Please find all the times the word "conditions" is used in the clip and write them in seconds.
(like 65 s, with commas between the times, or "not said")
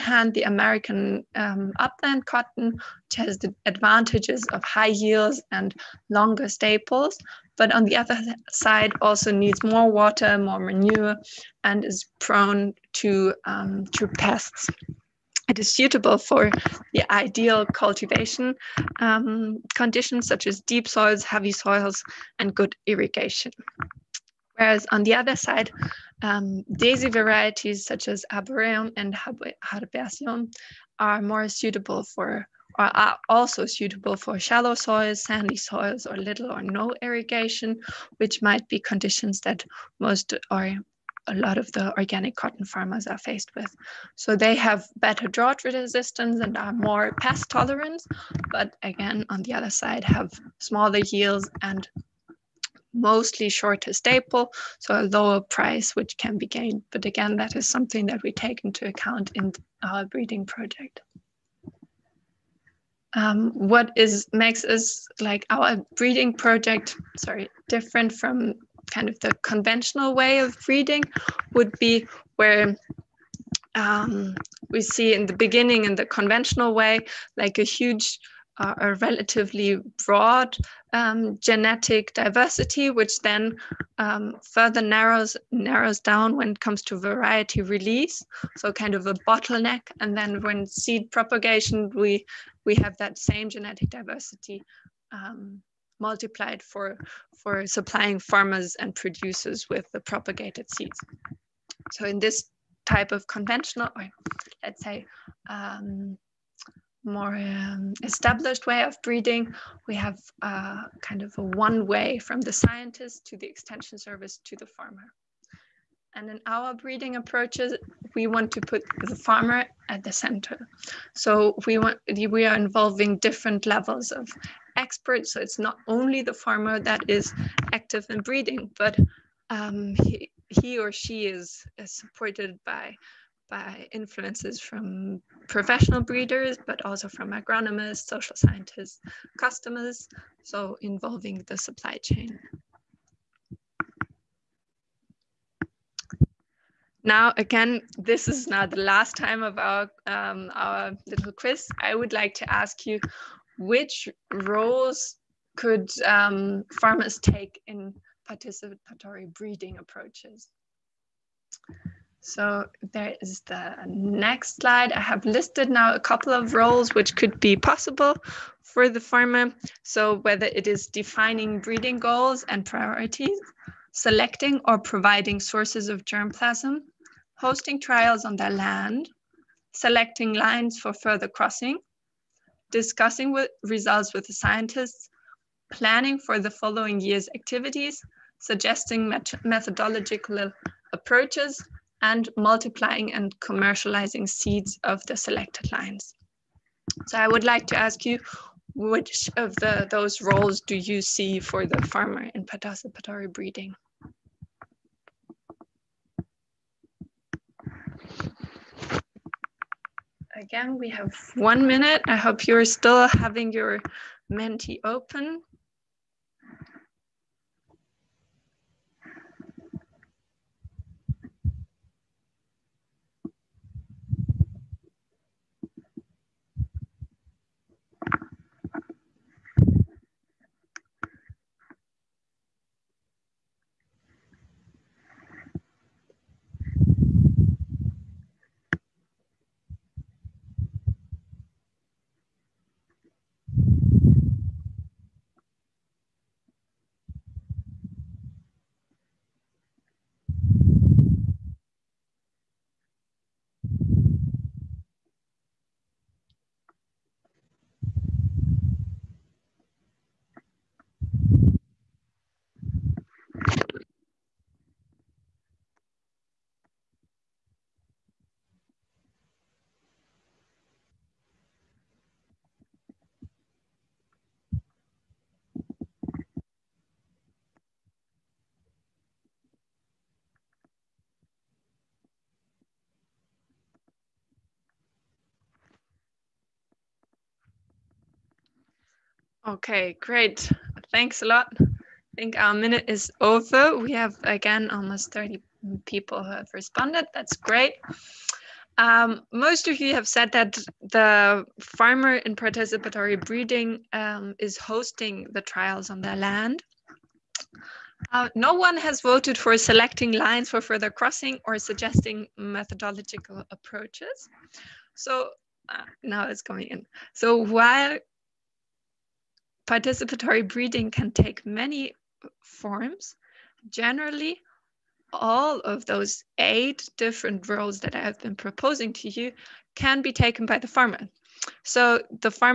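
19 s, 38 s.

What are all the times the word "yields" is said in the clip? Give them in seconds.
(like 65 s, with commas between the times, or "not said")
5 s, 51 s.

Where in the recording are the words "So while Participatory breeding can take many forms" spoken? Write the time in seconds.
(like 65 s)
317 s.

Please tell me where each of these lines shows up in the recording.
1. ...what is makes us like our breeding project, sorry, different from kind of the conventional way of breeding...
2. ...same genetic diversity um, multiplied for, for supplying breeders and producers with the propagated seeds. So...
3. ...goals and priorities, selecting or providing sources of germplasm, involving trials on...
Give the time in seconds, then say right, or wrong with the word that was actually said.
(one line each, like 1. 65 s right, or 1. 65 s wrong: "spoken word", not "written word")
1. 63 s right
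2. 93 s wrong: "farmers", not "breeders"
3. 171 s wrong: "hosting", not "involving".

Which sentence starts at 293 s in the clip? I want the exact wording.
We have again almost 30 people who have responded.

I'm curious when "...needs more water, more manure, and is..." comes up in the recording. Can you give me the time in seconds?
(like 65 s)
9 s.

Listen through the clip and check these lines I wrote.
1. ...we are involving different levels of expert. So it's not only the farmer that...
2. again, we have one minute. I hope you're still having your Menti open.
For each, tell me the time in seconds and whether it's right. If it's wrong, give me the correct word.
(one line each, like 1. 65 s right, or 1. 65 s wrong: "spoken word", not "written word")
1. 122 s right
2. 210 s right.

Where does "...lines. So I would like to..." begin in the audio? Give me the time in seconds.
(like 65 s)
195 s.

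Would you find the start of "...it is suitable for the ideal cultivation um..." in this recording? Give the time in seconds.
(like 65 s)
15 s.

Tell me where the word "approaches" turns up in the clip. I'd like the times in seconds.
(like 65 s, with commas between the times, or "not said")
117 s, 159 s, 190 s, 313 s.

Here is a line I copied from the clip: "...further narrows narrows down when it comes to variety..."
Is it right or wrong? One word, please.
right.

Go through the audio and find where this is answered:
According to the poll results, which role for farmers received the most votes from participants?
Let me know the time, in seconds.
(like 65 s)
304 s.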